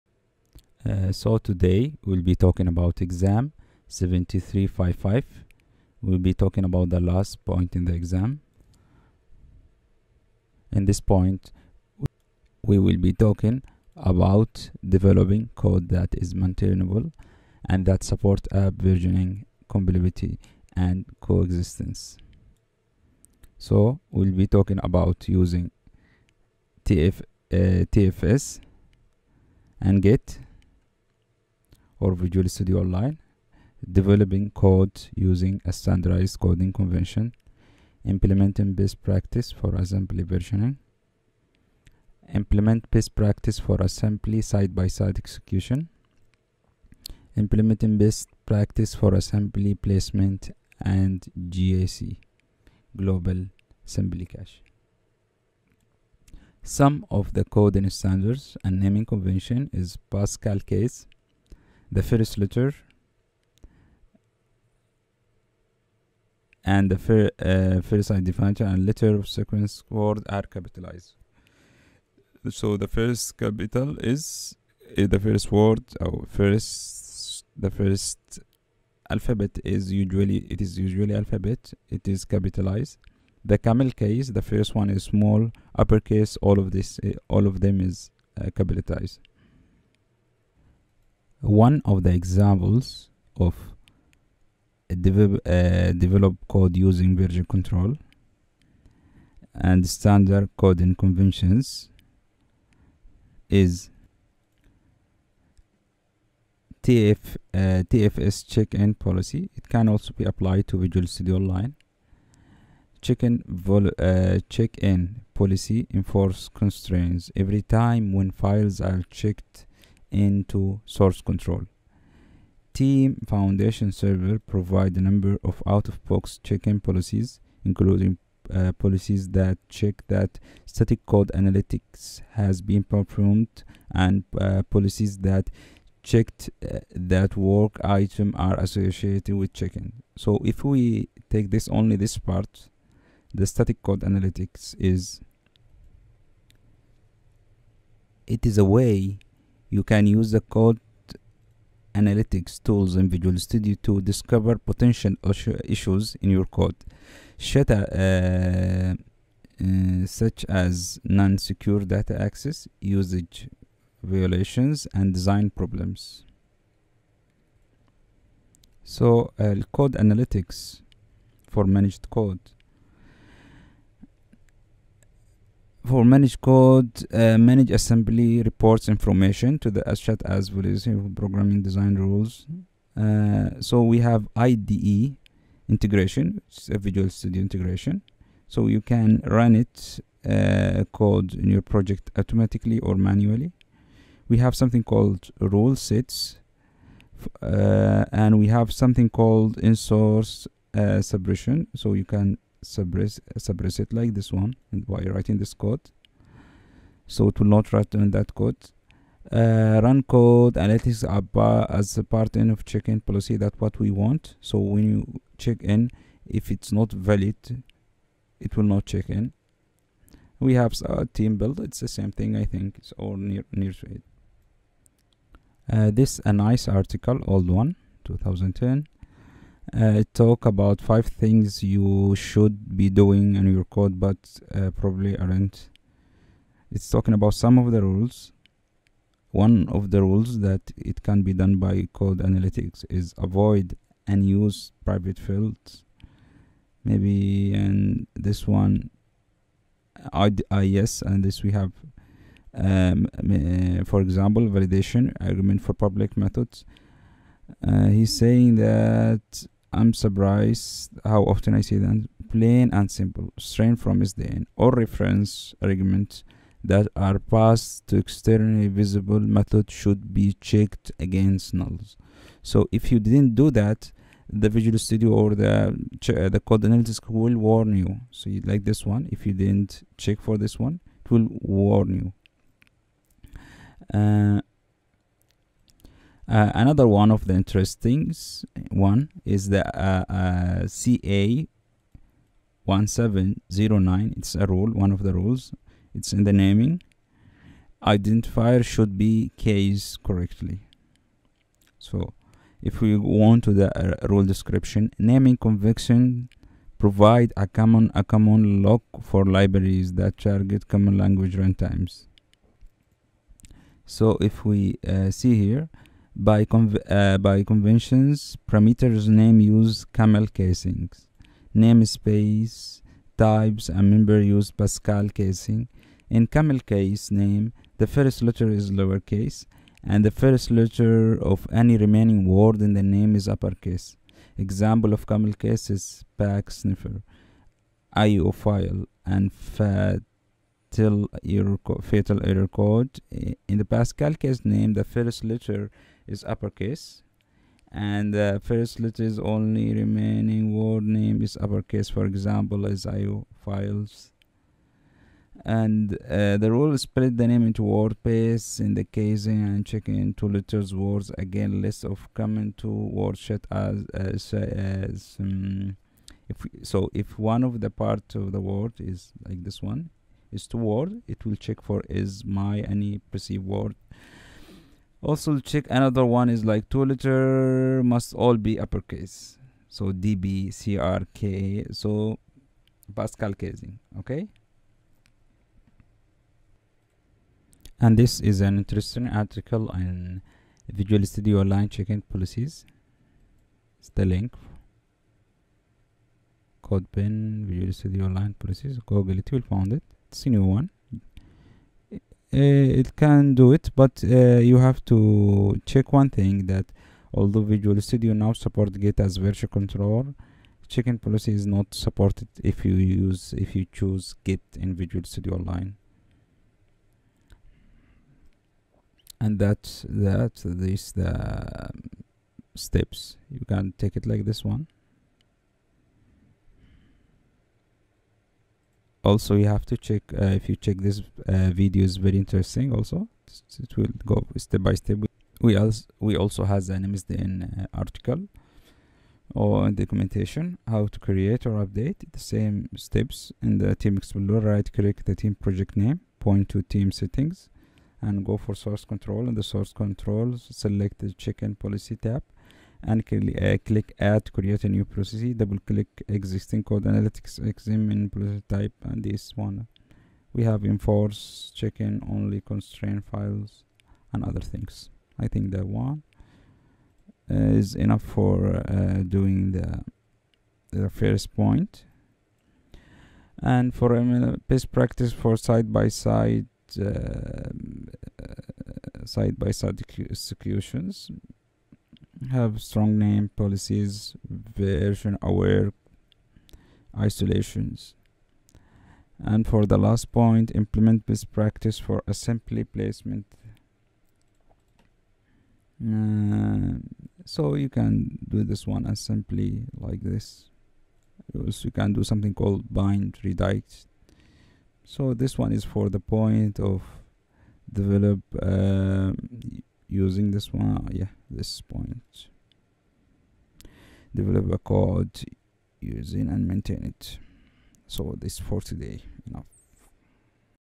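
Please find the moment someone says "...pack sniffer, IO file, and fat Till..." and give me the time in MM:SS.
05:36.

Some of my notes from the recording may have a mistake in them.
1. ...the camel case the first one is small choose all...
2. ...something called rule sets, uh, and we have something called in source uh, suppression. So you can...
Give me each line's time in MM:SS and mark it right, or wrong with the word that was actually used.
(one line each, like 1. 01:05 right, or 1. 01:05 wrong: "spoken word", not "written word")
1. 01:23 wrong: "uppercase", not "choose"
2. 03:14 right.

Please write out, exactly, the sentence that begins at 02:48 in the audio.
So uh, code analytics for managed code.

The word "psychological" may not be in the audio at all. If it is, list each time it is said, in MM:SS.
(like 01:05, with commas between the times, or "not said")
not said.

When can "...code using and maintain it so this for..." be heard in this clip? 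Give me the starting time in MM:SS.
08:34.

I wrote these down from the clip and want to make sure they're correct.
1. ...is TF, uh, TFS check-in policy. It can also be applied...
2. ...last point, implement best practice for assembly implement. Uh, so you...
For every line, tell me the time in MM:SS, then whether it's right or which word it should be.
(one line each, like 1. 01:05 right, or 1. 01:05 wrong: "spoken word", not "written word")
1. 01:43 right
2. 08:09 wrong: "placement", not "implement".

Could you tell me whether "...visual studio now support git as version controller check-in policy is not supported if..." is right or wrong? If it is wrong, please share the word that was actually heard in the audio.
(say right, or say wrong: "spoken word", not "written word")
right.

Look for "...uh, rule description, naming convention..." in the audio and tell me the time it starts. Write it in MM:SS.
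05:04.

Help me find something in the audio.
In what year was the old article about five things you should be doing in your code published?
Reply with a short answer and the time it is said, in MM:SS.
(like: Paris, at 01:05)
2010, at 03:48.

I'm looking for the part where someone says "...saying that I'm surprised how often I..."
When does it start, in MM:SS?
04:18.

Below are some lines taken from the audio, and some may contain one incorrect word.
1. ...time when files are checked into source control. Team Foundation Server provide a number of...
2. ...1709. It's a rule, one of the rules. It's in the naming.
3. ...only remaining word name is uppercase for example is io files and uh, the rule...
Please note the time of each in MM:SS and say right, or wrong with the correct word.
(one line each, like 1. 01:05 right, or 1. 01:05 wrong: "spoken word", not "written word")
1. 01:57 right
2. 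04:52 right
3. 05:49 right.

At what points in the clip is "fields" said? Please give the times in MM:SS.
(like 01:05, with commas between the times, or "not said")
04:05.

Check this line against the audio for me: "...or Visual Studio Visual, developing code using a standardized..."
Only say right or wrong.
wrong.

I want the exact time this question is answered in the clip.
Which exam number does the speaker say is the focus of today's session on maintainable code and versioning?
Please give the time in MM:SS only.
00:03.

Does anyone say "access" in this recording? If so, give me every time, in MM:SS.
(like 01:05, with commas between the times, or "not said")
02:42.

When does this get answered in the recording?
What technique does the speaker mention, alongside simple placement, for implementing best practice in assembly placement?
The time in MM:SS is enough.
08:22.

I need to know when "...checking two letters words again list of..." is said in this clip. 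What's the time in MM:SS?
05:59.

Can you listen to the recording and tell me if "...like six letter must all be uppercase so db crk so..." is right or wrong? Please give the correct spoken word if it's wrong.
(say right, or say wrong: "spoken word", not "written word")
wrong: "two", not "six".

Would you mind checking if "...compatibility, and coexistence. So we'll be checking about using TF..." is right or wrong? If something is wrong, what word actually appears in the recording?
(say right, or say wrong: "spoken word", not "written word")
wrong: "talking", not "checking".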